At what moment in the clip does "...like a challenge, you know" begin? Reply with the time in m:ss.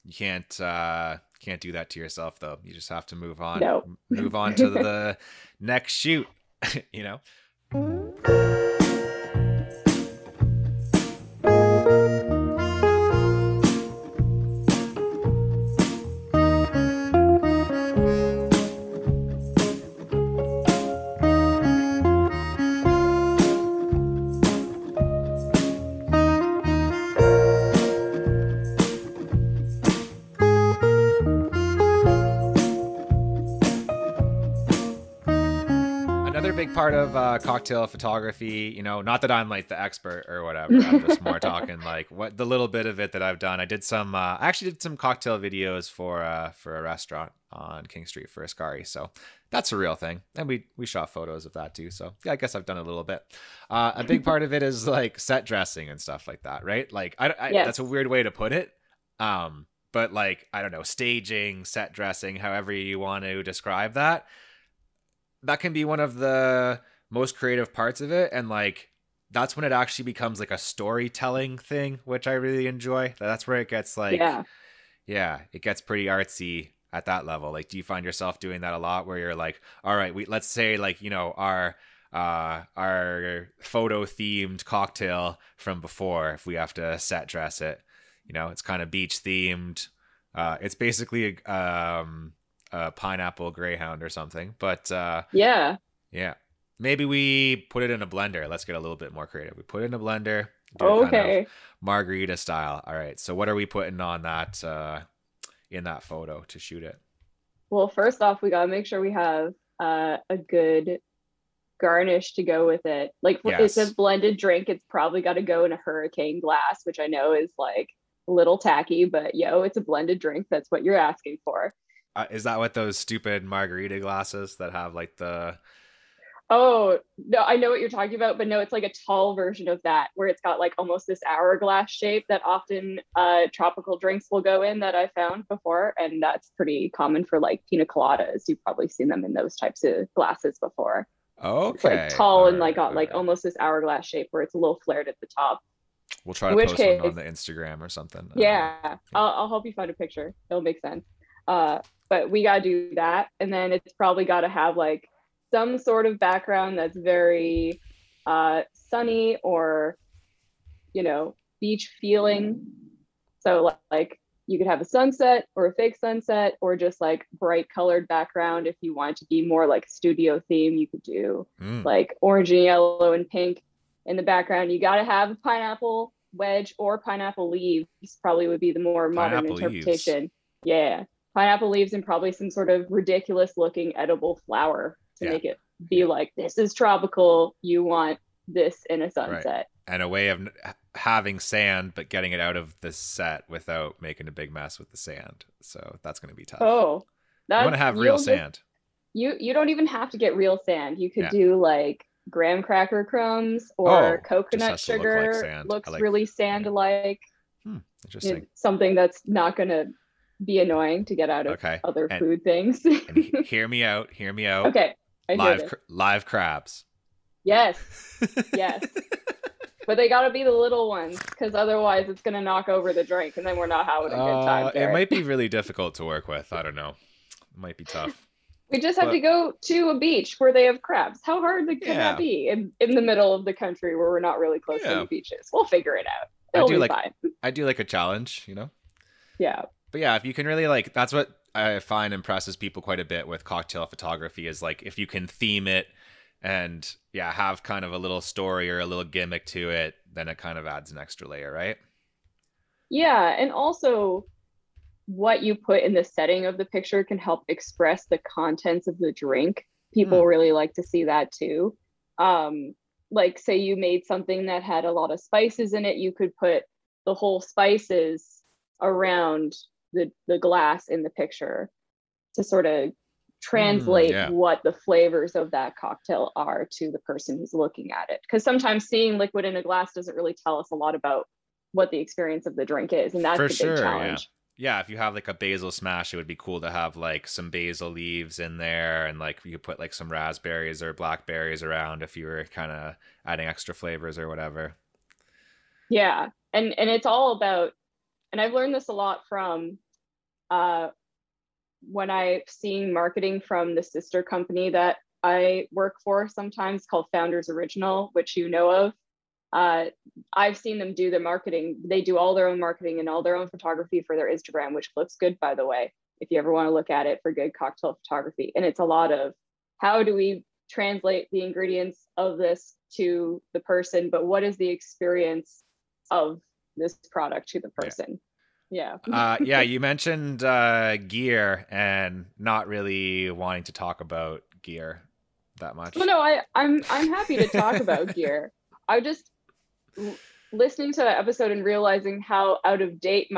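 3:57.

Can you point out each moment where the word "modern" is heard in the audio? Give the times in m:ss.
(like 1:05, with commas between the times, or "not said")
2:59.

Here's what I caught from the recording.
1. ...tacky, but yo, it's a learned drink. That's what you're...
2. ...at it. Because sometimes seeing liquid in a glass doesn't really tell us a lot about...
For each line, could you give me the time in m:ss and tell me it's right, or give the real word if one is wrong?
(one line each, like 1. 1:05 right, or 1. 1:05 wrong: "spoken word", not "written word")
1. 1:58 wrong: "blended", not "learned"
2. 4:37 right.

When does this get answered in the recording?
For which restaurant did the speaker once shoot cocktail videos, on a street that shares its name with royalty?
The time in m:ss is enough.
0:48.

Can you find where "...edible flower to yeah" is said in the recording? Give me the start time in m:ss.
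3:03.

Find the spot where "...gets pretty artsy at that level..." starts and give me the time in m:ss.
1:15.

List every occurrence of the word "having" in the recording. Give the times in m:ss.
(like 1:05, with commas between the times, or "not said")
3:10, 3:43.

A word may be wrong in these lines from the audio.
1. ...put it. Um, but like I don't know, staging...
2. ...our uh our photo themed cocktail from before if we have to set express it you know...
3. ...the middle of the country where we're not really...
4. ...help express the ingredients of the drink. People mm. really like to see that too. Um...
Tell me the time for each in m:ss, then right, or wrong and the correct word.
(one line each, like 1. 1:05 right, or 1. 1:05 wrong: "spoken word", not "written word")
1. 0:58 right
2. 1:21 wrong: "dress", not "express"
3. 3:52 right
4. 4:17 wrong: "contents", not "ingredients".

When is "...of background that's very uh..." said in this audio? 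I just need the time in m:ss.
2:36.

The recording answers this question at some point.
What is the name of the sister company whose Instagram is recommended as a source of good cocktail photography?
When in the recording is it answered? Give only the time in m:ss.
5:07.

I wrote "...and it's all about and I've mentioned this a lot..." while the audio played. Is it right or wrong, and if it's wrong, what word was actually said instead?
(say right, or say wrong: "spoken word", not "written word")
wrong: "learned", not "mentioned".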